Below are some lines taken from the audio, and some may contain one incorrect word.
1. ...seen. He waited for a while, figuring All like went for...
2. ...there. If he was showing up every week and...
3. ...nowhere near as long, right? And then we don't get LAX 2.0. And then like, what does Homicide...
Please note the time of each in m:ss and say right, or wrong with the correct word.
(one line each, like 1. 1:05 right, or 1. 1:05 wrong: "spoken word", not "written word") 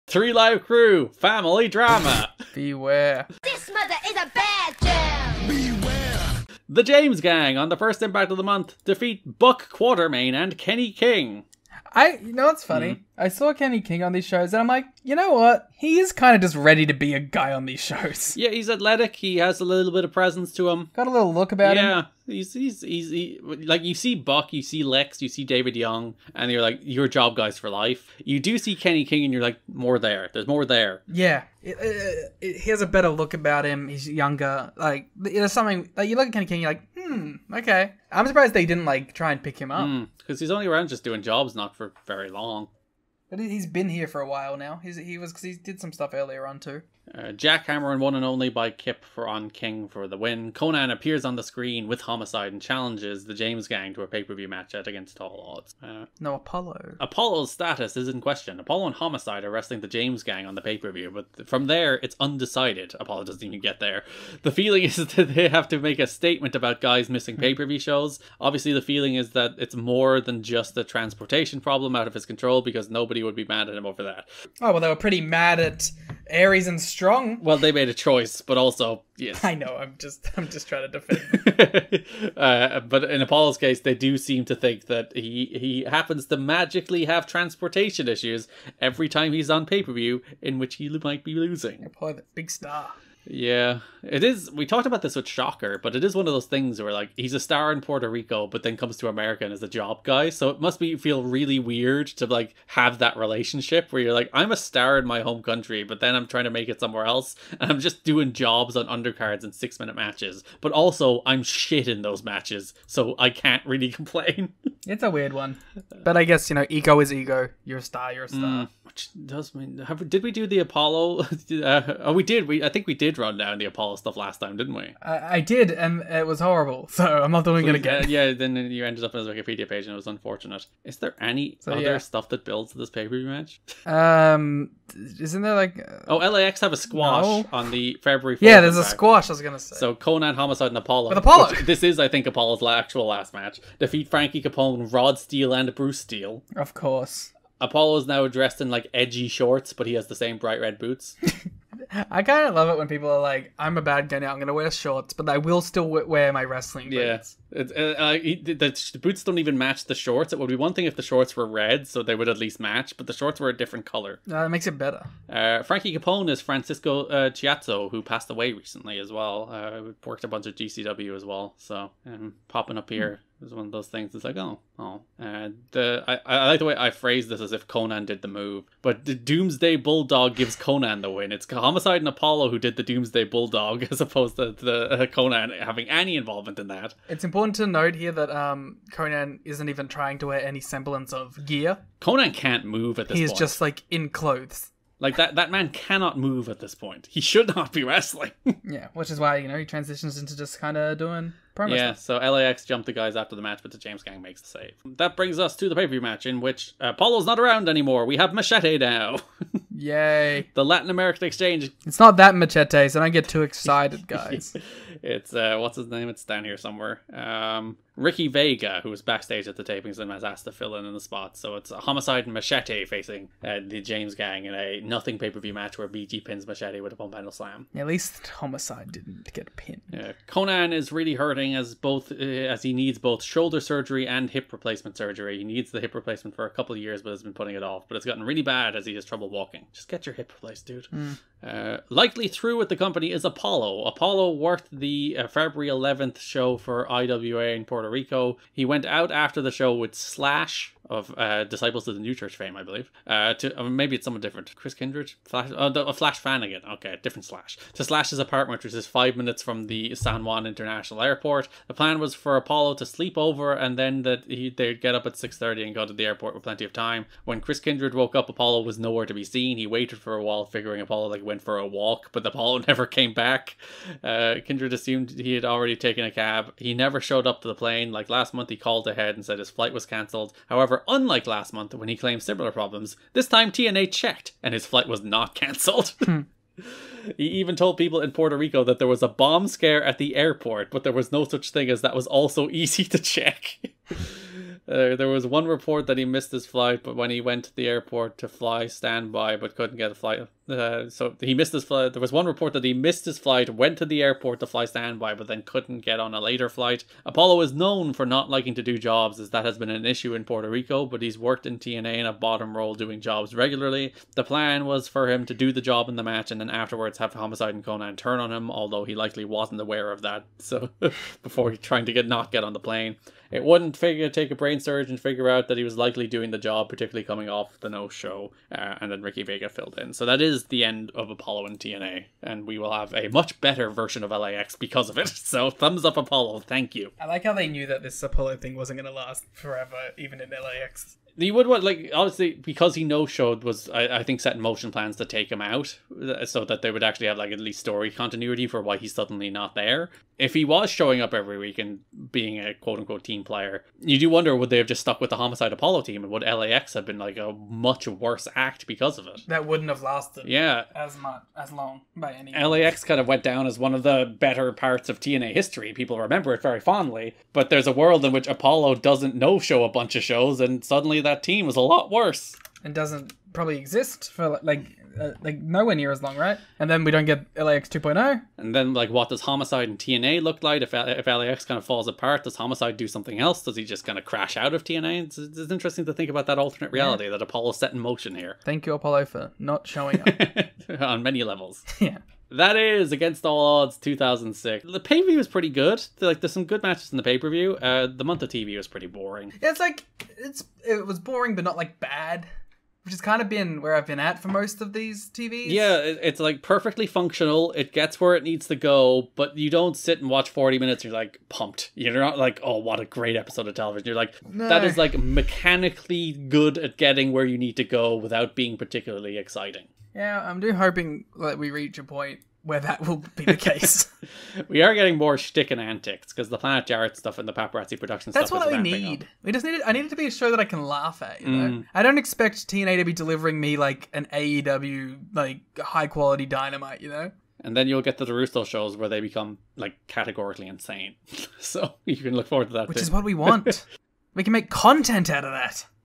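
1. 4:29 wrong: "Apolo", not "All"
2. 5:49 right
3. 6:15 right.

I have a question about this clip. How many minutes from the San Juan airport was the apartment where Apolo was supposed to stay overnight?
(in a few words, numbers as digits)
5.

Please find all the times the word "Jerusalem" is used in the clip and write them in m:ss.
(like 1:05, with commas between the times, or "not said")
7:18.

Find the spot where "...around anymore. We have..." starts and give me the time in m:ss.
3:27.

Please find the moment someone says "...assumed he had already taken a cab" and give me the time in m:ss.
4:34.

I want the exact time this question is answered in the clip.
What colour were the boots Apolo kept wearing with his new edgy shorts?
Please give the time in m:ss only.
2:30.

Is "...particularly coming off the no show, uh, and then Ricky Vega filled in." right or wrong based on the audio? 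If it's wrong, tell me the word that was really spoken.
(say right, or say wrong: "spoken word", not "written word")
right.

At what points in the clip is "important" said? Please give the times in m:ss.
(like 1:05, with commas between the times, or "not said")
3:07.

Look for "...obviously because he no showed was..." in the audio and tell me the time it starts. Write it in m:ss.
5:41.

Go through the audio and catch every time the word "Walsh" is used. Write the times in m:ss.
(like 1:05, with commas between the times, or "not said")
not said.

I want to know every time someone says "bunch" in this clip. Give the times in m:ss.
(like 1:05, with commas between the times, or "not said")
2:50, 6:09.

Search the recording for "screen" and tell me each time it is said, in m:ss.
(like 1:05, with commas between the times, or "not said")
0:51.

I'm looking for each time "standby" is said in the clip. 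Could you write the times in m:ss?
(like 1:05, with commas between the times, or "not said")
4:58, 5:04.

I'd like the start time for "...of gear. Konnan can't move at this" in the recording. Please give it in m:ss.
3:11.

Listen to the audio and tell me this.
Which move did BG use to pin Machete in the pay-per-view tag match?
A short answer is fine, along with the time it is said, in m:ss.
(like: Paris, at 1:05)
Pump handle slam, at 3:46.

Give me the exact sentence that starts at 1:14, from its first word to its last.
Oh, well, they were pretty mad at Aries and Strong.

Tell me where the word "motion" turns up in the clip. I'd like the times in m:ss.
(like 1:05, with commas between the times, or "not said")
5:44, 6:27.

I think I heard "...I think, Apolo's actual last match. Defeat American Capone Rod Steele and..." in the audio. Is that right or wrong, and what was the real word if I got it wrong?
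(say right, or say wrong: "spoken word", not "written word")
wrong: "Frankie", not "American".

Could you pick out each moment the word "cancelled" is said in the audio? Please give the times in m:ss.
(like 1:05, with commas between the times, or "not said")
4:39, 4:45.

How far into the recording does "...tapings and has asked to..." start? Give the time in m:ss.
3:39.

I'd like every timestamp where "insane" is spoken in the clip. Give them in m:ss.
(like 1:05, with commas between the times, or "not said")
7:20.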